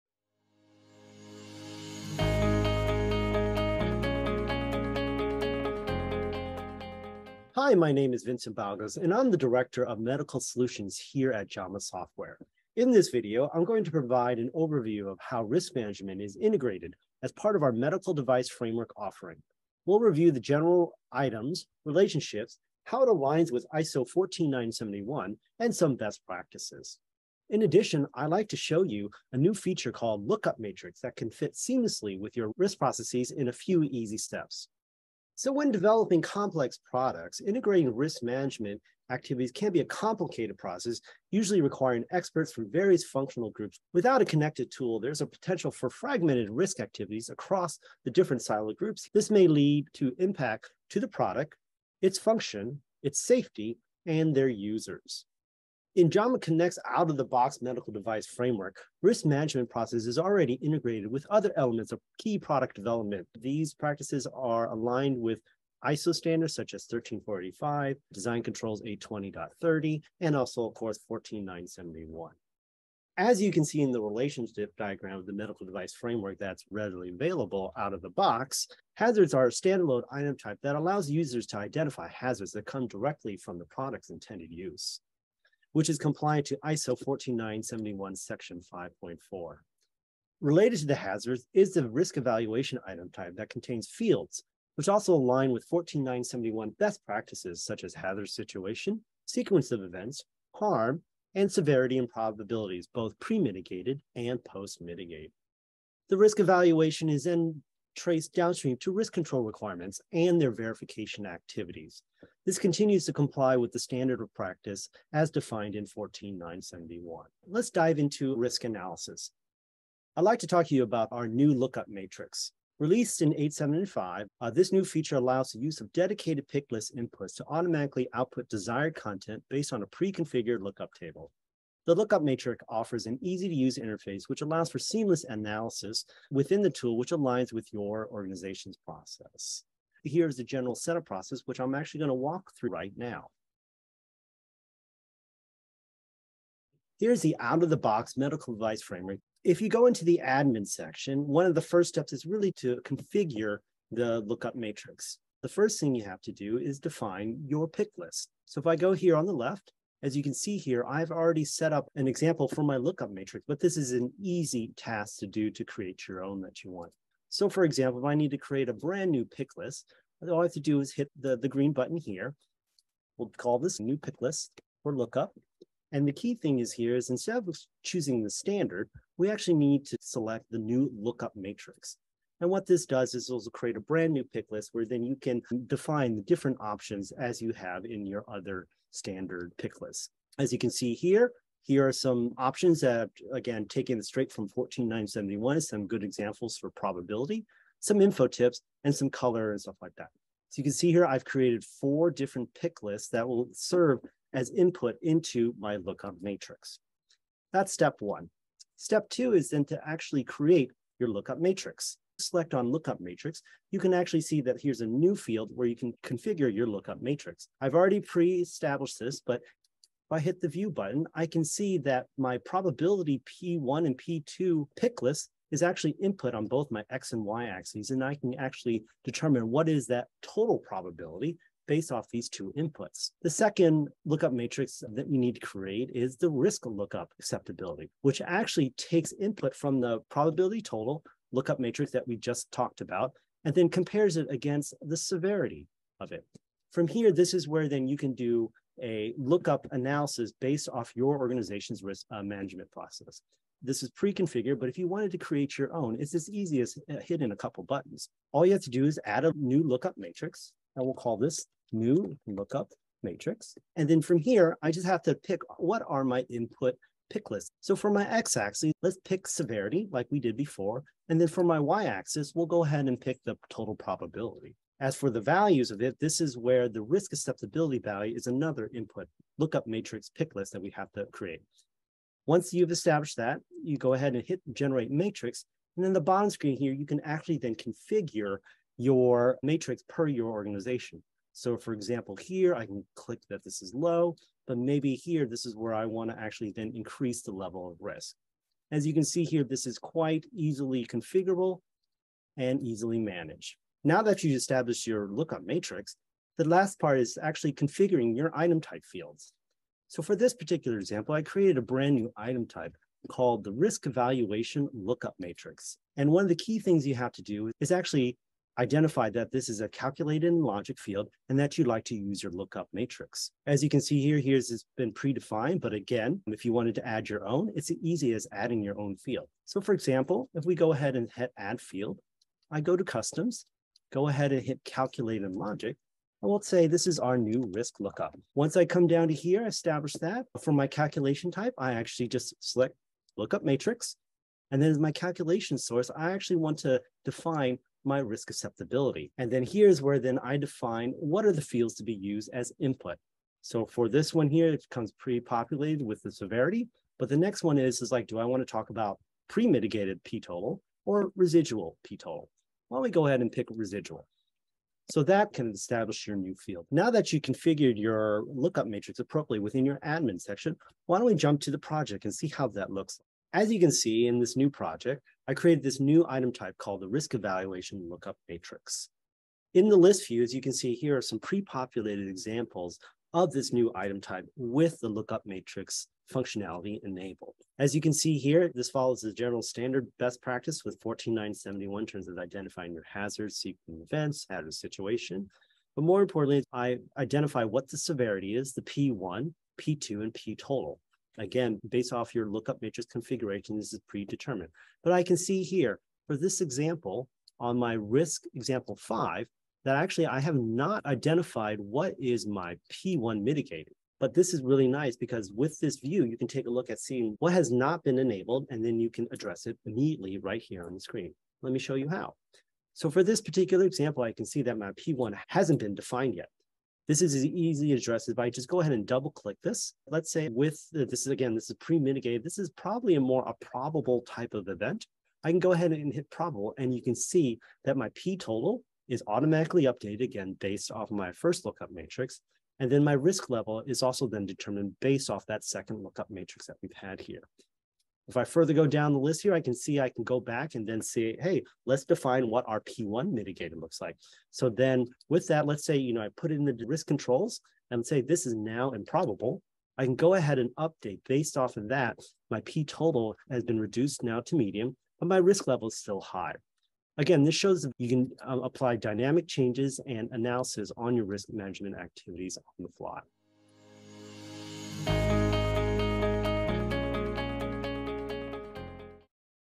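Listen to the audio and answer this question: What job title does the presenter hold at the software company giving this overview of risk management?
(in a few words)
Director of Medical Solutions.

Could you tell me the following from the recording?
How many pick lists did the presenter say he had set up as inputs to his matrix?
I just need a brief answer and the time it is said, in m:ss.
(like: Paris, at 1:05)
4, at 3:21.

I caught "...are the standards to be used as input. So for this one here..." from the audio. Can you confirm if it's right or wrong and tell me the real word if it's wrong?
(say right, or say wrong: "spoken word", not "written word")
wrong: "fields", not "standards".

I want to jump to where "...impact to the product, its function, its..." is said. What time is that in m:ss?
0:50.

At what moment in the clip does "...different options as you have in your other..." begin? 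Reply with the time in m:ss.
3:06.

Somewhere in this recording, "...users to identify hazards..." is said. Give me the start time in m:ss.
1:21.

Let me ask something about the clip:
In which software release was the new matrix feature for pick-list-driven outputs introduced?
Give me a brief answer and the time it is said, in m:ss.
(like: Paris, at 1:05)
8.7.5, at 2:03.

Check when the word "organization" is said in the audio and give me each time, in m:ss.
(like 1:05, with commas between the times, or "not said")
2:18, 4:11, 4:50.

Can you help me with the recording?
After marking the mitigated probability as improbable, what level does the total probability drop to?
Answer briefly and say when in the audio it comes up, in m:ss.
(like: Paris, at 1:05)
Medium, at 7:44.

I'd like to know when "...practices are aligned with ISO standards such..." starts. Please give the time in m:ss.
1:03.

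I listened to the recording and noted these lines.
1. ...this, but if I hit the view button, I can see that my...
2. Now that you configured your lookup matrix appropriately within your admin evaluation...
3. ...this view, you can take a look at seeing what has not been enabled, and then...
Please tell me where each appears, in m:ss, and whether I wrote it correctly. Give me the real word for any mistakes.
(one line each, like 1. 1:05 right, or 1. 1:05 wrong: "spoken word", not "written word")
1. 3:38 right
2. 6:06 wrong: "section", not "evaluation"
3. 6:55 right.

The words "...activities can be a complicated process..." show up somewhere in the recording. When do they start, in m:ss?
0:39.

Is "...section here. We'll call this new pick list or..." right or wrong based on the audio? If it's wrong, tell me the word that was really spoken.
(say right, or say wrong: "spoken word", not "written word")
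wrong: "button", not "section".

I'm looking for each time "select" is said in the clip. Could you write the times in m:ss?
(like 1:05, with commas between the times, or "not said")
3:00, 3:32, 5:42.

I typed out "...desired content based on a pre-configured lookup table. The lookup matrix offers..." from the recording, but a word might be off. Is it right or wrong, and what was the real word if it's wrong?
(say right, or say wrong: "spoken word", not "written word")
right.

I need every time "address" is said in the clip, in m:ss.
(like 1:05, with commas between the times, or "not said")
6:59, 7:07.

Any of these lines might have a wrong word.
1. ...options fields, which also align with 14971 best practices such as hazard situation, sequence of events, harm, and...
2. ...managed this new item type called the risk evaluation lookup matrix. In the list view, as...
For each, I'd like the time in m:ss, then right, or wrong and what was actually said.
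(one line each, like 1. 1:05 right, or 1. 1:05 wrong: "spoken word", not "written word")
1. 1:33 wrong: "contains", not "options"
2. 6:15 wrong: "created", not "managed".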